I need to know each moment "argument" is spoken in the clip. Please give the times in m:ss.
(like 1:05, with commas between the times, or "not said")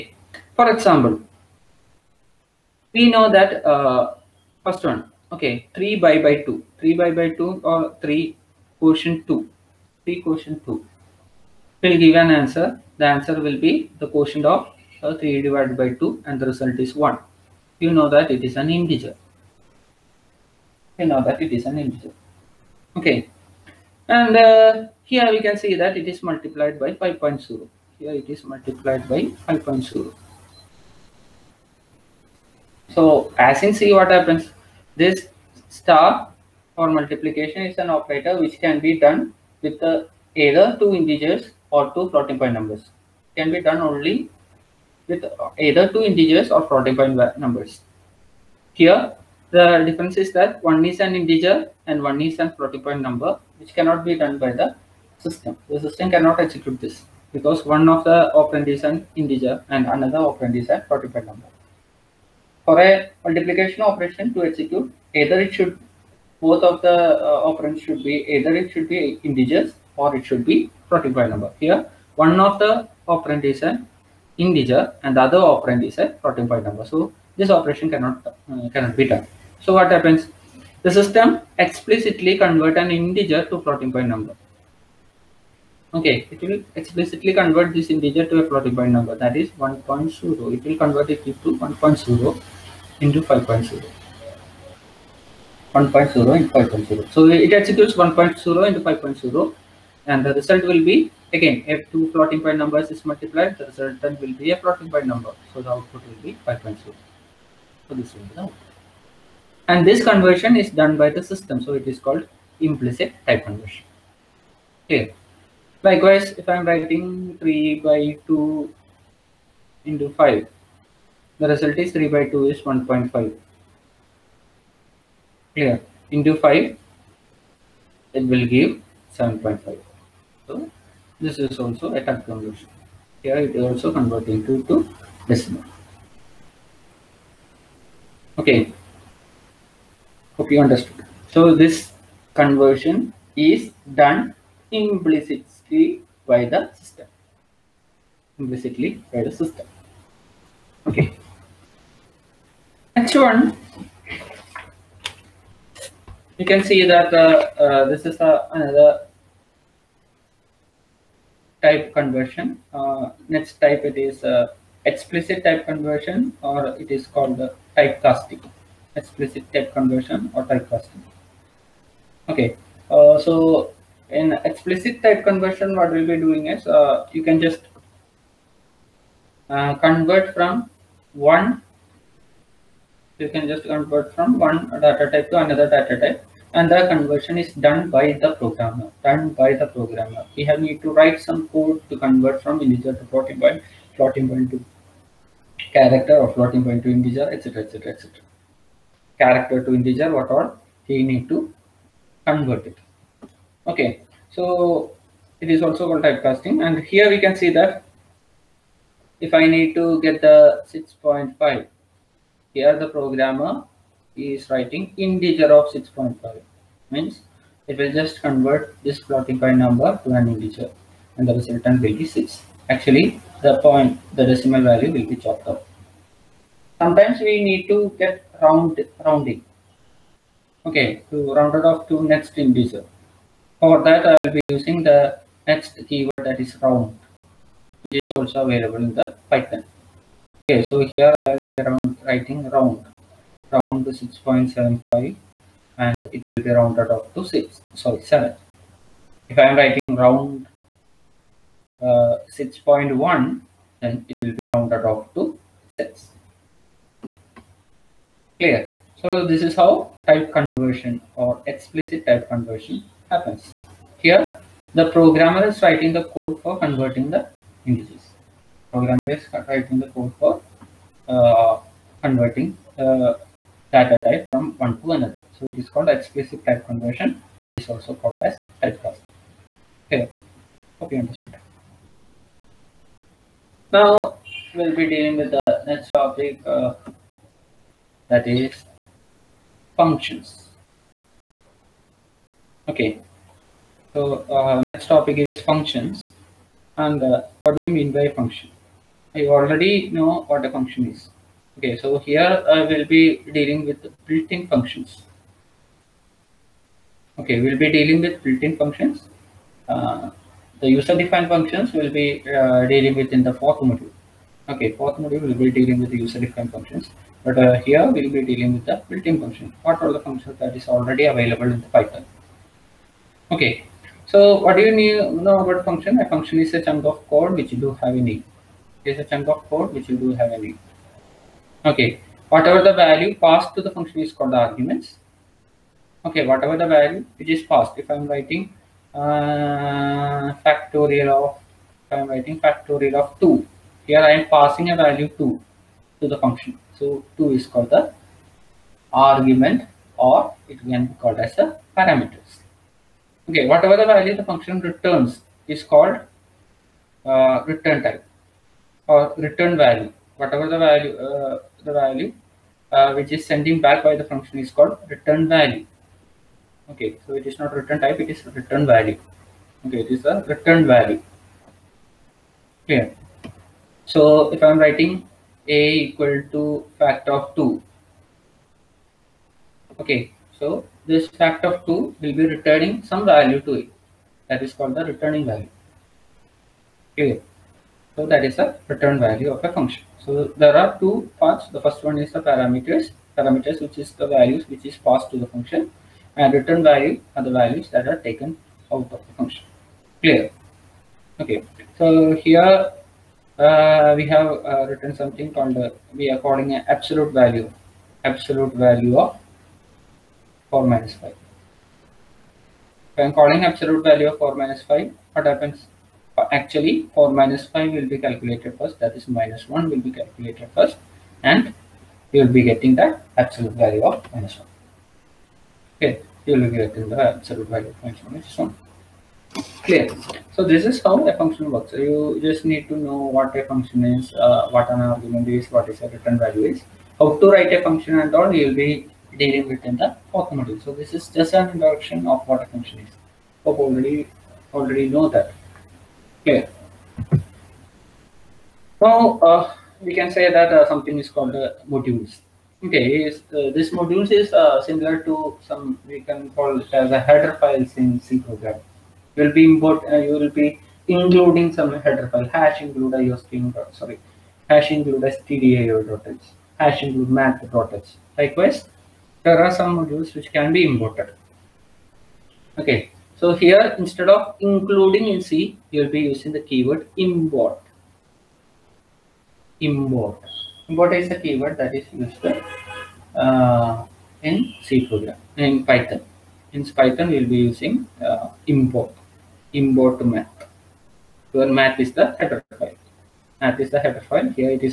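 5:34, 5:48, 7:14.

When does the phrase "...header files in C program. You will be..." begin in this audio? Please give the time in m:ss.
7:36.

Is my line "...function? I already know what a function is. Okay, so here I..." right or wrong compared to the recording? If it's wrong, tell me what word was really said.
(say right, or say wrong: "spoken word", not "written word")
right.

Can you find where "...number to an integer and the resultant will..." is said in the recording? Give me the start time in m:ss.
3:39.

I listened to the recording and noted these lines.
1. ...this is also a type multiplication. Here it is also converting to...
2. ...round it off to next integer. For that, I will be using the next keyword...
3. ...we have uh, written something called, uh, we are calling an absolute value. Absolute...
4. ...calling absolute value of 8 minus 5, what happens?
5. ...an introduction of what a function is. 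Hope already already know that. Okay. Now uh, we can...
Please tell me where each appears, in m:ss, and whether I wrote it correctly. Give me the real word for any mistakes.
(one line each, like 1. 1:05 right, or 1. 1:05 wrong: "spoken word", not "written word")
1. 2:11 wrong: "conversion", not "multiplication"
2. 3:51 right
3. 6:43 right
4. 6:53 wrong: "4", not "8"
5. 7:21 right.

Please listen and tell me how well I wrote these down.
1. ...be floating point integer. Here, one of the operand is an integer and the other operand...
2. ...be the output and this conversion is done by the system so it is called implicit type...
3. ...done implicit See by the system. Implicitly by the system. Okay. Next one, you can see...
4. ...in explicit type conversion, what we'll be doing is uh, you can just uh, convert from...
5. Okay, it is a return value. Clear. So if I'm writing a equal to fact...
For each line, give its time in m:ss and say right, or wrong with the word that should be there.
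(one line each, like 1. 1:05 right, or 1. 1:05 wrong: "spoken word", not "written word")
1. 1:10 wrong: "number", not "integer"
2. 1:48 right
3. 2:23 right
4. 2:54 right
5. 6:09 right.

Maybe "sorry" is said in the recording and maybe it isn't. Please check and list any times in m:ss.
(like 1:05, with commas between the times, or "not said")
4:07, 7:43.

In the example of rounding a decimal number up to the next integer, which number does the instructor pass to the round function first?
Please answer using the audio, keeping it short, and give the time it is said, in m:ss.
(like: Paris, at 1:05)
6.75, at 4:03.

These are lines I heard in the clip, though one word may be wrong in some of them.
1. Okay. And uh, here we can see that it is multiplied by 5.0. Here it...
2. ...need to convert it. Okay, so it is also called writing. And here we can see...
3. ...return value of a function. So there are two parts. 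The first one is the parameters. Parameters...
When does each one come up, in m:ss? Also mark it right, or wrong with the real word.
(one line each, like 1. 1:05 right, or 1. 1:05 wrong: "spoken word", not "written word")
1. 0:22 right
2. 3:21 wrong: "typecasting", not "writing"
3. 6:28 right.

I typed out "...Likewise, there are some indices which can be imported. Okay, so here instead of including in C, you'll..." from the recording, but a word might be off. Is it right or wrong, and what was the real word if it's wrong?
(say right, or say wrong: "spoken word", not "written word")
wrong: "modules", not "indices".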